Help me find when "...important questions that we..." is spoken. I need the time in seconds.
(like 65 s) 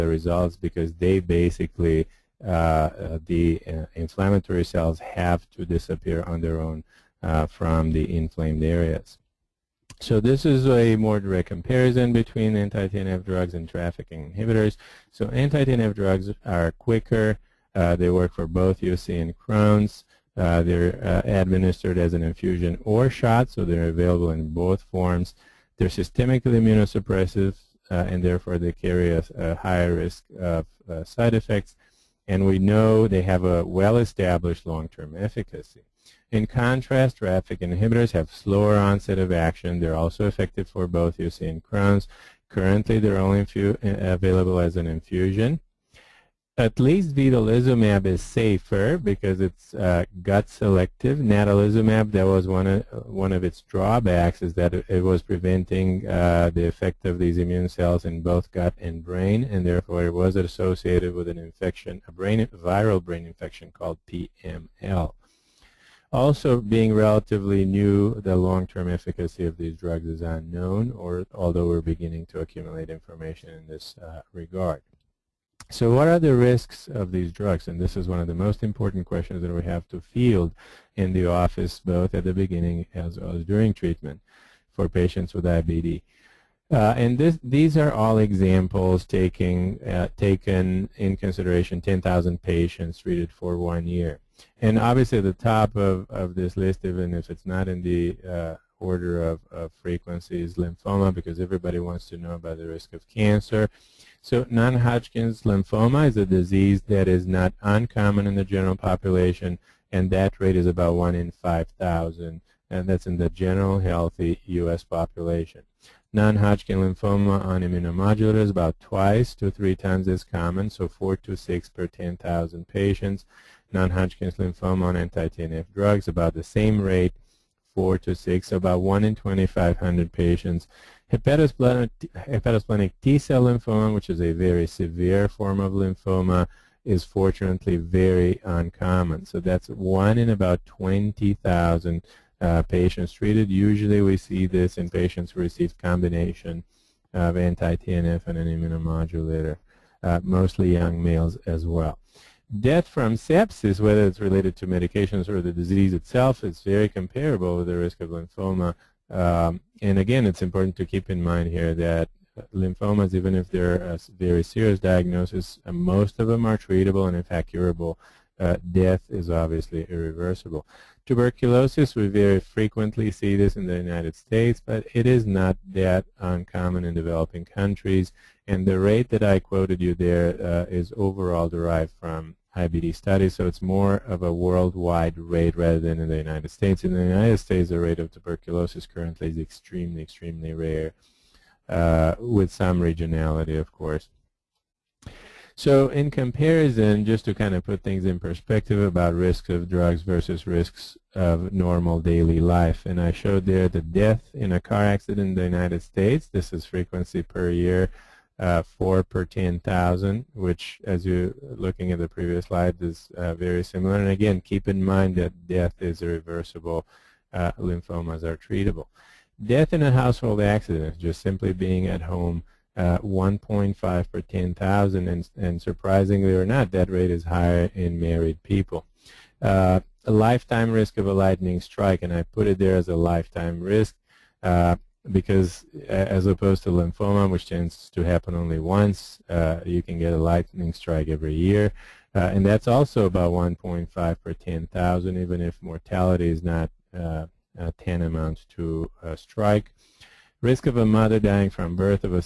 78 s.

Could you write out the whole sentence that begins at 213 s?
And again, keep in mind that death is irreversible.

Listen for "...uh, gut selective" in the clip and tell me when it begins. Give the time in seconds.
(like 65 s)
49 s.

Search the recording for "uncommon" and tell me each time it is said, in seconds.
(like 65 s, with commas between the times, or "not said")
107 s, 138 s, 176 s.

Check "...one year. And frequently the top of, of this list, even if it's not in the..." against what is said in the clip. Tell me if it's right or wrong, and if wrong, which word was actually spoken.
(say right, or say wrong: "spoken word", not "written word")
wrong: "obviously", not "frequently".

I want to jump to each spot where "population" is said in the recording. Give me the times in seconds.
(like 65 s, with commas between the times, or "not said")
108 s, 114 s.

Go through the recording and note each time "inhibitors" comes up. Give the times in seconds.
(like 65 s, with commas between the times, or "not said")
14 s, 37 s.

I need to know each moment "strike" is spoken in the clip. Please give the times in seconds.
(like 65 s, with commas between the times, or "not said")
231 s, 240 s, 249 s.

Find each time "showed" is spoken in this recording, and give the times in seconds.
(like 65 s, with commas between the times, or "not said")
203 s.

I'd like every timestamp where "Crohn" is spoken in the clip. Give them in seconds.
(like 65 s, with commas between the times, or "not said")
19 s, 41 s.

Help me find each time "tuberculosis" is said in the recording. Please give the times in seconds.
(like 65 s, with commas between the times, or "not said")
171 s, 188 s.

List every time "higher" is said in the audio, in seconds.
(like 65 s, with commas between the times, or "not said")
29 s, 227 s.